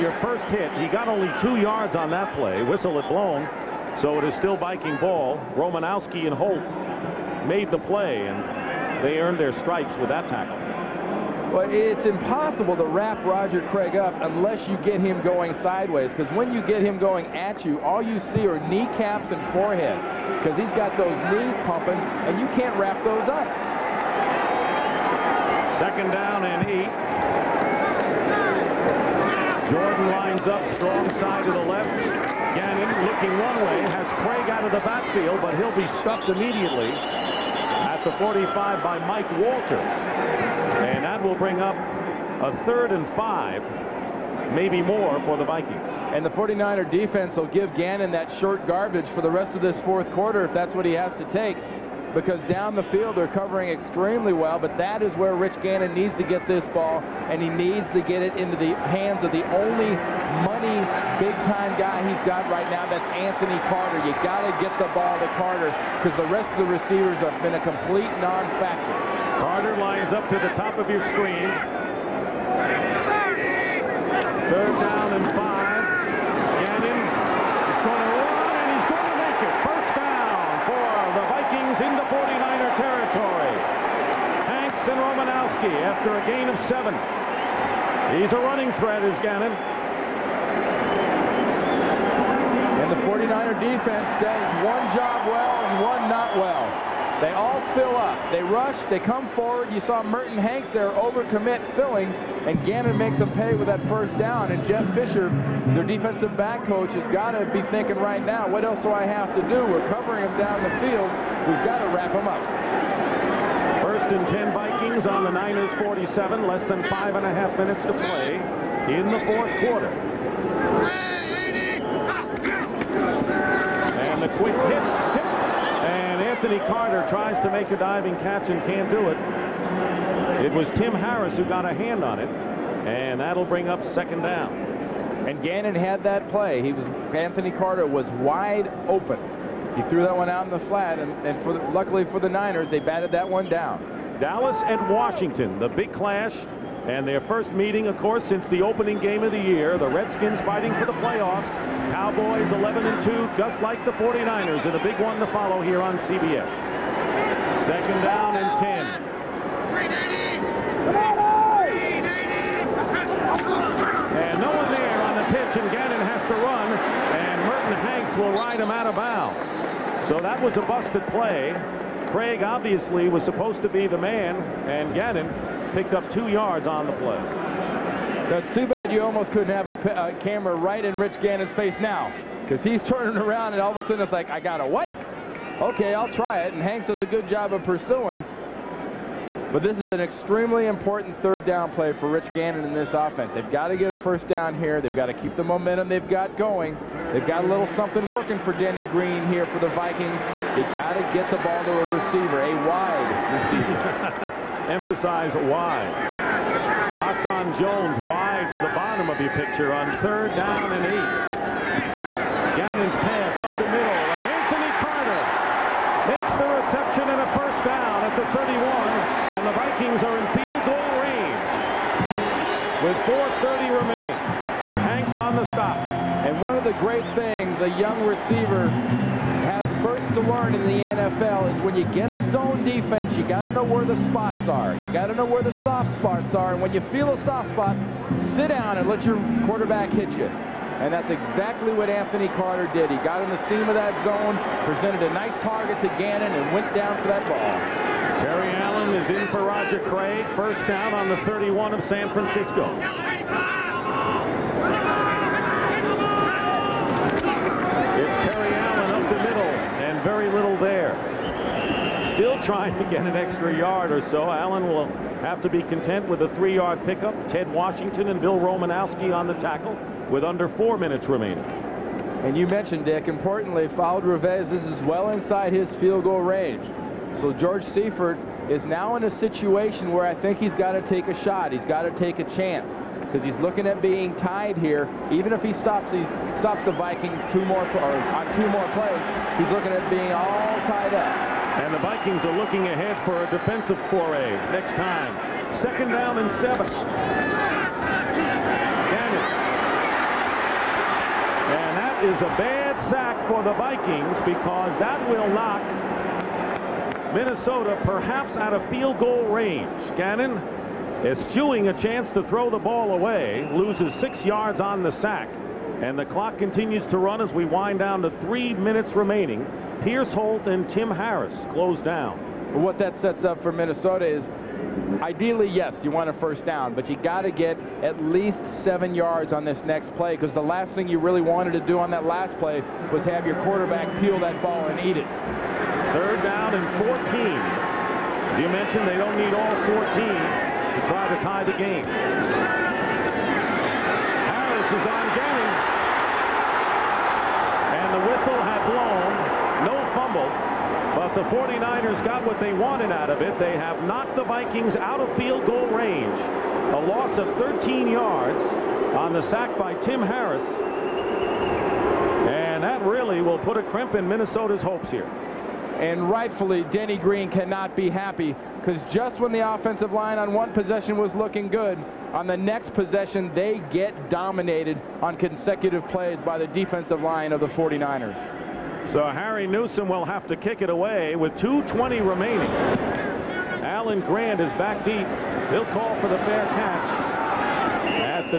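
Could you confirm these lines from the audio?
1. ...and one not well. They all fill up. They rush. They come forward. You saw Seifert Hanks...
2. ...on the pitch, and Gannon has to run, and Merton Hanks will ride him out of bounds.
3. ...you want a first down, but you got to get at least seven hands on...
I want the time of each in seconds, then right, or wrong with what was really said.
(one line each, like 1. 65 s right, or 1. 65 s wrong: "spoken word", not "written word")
1. 95 s wrong: "Merton", not "Seifert"
2. 165 s right
3. 325 s wrong: "yards", not "hands".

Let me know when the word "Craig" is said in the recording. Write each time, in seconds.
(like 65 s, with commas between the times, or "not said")
13 s, 34 s, 172 s, 249 s.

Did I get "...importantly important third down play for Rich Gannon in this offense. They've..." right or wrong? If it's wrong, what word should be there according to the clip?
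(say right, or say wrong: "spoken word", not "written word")
wrong: "extremely", not "importantly".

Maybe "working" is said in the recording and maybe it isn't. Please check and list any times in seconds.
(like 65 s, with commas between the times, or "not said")
198 s.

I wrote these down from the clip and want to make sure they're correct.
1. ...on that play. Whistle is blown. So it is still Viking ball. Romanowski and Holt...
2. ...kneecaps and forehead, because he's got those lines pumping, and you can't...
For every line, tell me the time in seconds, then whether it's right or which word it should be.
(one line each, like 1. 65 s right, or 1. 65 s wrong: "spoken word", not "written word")
1. 1 s right
2. 18 s wrong: "knees", not "lines".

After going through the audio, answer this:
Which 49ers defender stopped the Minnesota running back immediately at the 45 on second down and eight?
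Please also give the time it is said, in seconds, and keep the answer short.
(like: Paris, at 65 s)
Mike Walter, at 39 s.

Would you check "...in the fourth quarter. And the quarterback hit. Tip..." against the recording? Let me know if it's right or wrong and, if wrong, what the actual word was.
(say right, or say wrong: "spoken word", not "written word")
wrong: "quick", not "quarterback".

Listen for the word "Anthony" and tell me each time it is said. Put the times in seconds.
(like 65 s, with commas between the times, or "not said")
63 s, 126 s, 137 s, 214 s, 241 s.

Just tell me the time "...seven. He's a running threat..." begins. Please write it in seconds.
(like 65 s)
86 s.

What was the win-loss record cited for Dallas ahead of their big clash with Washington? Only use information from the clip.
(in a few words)
11 and 2.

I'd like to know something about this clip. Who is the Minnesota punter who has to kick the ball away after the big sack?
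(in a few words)
Harry Newsome.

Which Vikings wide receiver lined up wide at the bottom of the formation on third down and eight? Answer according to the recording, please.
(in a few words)
Hassan Jones.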